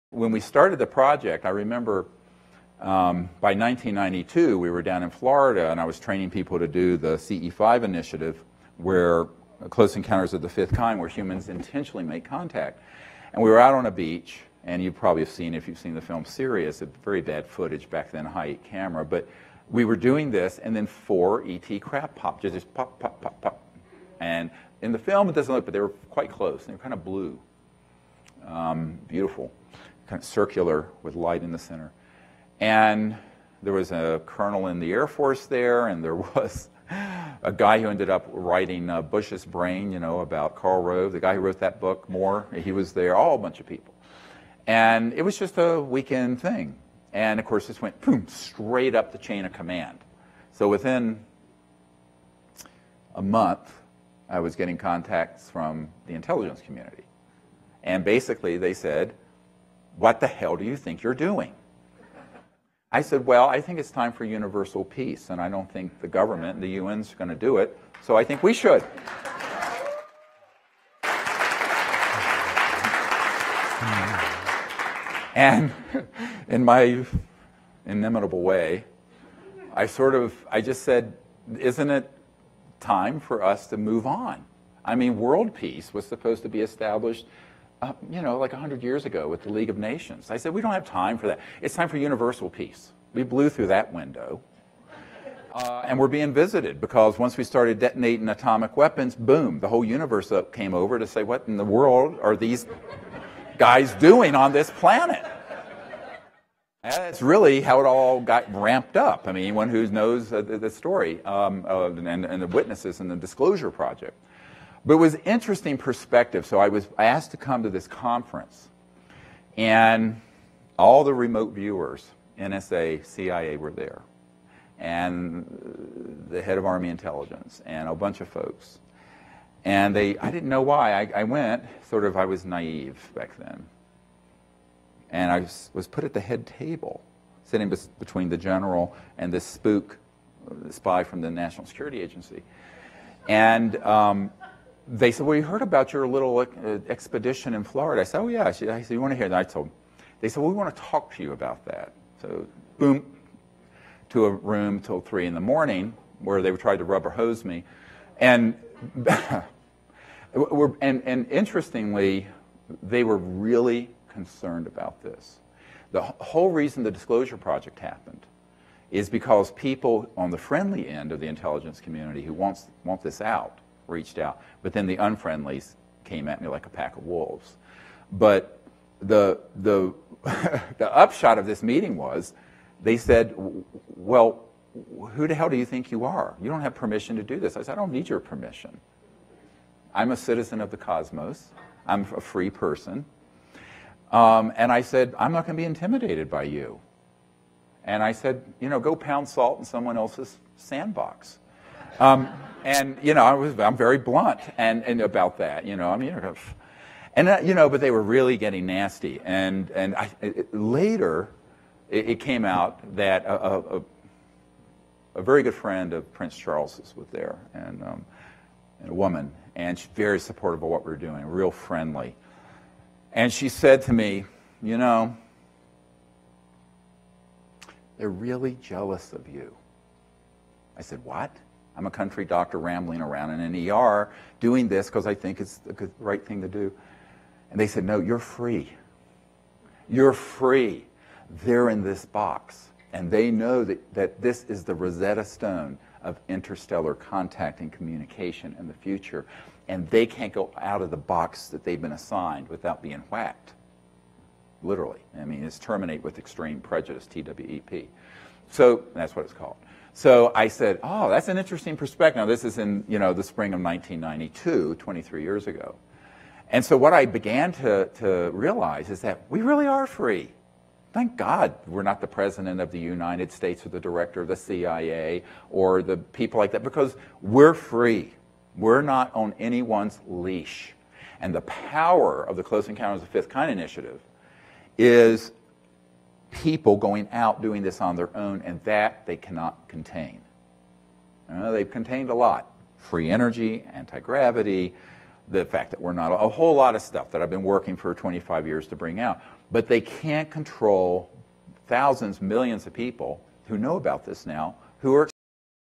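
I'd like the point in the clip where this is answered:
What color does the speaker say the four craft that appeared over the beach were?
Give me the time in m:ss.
0:27.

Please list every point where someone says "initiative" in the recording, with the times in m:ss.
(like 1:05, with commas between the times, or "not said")
0:07, 4:43.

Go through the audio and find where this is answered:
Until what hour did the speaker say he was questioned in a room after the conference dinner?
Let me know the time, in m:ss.
2:34.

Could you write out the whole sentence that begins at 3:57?
And they said, No, you're free.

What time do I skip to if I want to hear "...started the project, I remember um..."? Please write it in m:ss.
0:00.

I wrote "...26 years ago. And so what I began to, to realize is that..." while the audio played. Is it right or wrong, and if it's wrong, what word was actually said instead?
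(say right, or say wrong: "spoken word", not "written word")
wrong: "23", not "26".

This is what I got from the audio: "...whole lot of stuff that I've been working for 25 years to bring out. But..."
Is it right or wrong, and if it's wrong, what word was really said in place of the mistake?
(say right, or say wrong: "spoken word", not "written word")
right.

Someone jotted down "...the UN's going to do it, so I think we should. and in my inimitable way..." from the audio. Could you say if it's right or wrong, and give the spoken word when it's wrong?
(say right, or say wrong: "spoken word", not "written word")
right.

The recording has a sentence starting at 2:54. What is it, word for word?
But then the unfriendlies came at me like a pack of wolves.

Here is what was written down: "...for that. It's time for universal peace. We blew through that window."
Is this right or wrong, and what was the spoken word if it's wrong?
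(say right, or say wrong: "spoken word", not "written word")
right.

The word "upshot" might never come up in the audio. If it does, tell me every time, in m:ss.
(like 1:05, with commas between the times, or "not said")
3:00.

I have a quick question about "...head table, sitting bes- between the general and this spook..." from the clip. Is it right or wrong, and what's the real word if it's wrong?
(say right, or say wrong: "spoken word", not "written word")
right.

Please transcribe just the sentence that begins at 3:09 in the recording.
I'm a citizen of the cosmos.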